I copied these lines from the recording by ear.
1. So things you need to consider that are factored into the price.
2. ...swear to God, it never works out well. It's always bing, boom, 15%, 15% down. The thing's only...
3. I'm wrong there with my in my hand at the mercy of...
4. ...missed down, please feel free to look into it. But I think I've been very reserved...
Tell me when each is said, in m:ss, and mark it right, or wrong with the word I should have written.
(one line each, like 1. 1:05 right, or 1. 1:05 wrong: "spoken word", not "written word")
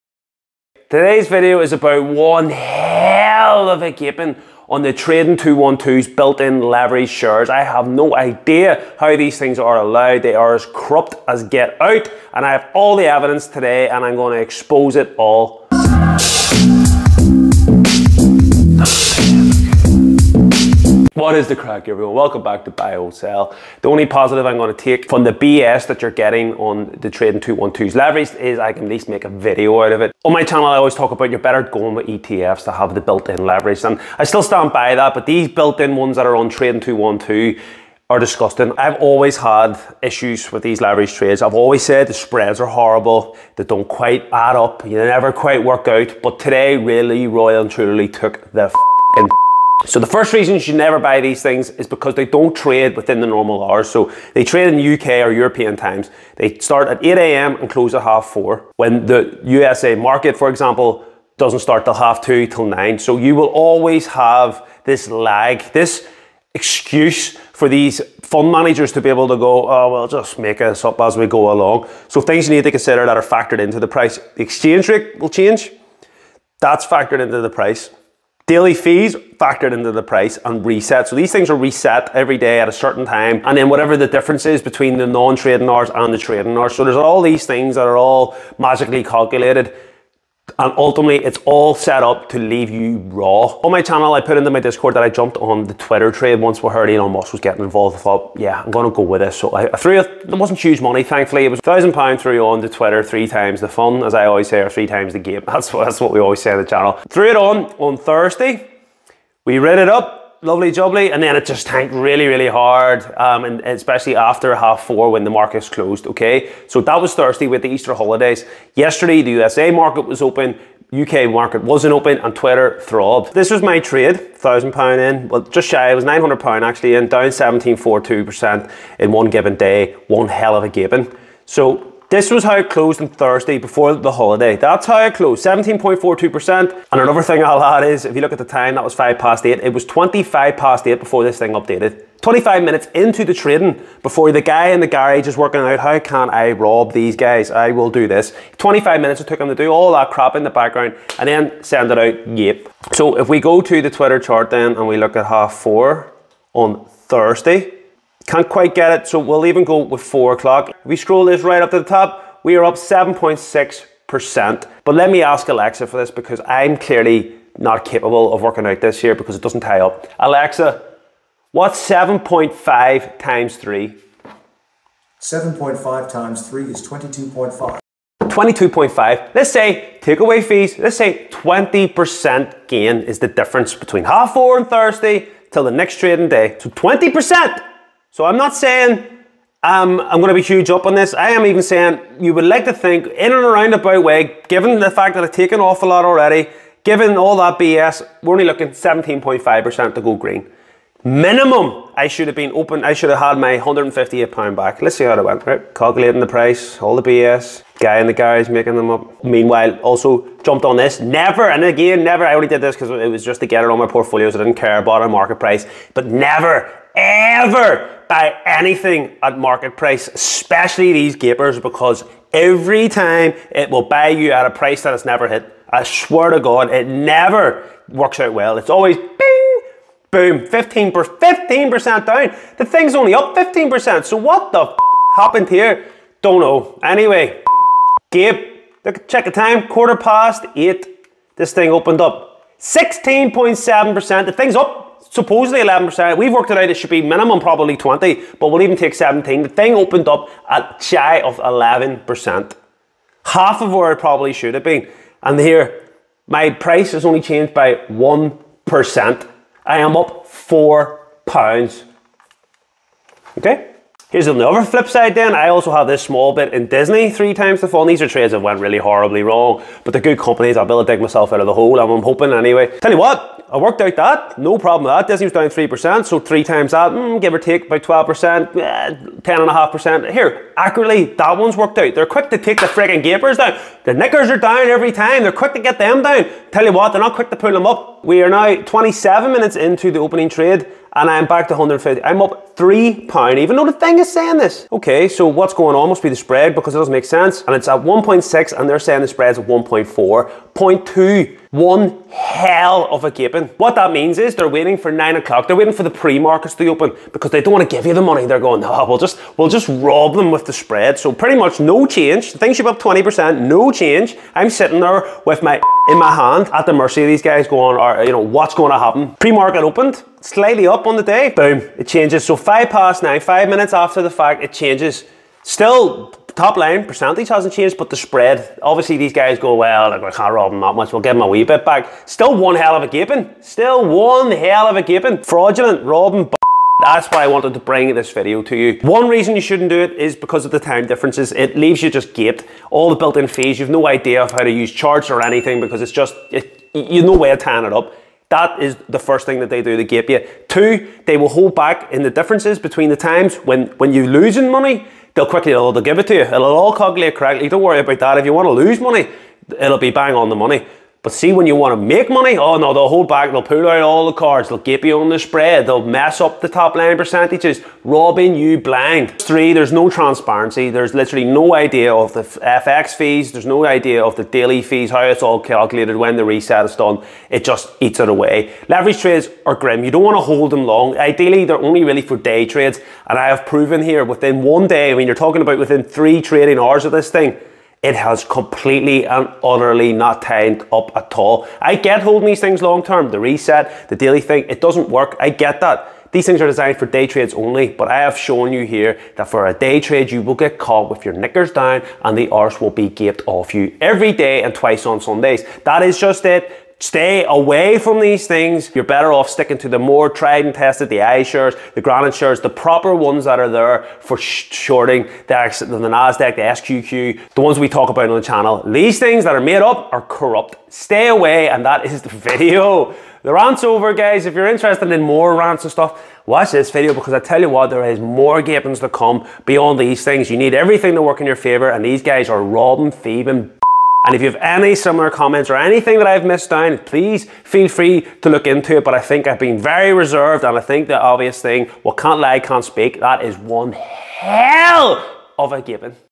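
1. 1:12 right
2. 3:45 right
3. 5:14 wrong: "sitting", not "wrong"
4. 7:16 right.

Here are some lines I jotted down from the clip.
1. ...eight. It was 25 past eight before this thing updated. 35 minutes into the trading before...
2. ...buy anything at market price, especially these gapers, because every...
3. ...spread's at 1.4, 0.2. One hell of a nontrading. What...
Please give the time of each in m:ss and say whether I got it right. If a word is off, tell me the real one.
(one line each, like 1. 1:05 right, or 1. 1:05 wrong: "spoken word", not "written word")
1. 2:19 wrong: "25", not "35"
2. 3:38 right
3. 4:59 wrong: "gaping", not "nontrading".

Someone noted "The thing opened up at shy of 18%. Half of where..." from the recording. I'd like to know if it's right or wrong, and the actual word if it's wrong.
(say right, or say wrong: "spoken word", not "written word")
wrong: "11", not "18".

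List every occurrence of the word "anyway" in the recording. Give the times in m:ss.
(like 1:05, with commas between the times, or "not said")
3:56, 4:32.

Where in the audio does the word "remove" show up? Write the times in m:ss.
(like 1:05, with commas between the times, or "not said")
not said.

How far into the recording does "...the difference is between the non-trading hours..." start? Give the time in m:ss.
1:23.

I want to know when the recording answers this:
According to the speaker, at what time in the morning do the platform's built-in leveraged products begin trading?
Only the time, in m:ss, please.
0:57.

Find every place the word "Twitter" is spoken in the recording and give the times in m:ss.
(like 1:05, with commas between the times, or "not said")
1:35, 1:42, 2:02, 2:33.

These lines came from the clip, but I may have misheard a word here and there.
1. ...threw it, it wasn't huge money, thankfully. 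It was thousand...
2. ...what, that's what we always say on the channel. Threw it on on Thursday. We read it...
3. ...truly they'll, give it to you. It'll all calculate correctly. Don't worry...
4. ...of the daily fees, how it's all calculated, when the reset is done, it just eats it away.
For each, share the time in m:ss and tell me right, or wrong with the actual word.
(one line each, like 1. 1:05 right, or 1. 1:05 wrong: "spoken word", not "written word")
1. 1:39 right
2. 1:45 right
3. 5:55 wrong: "quickly", not "truly"
4. 6:14 right.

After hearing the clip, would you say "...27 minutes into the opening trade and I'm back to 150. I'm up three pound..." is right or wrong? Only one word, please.
right.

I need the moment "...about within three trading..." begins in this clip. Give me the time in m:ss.
6:25.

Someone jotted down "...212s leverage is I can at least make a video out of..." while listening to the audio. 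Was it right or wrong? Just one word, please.
right.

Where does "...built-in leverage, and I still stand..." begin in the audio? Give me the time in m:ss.
0:33.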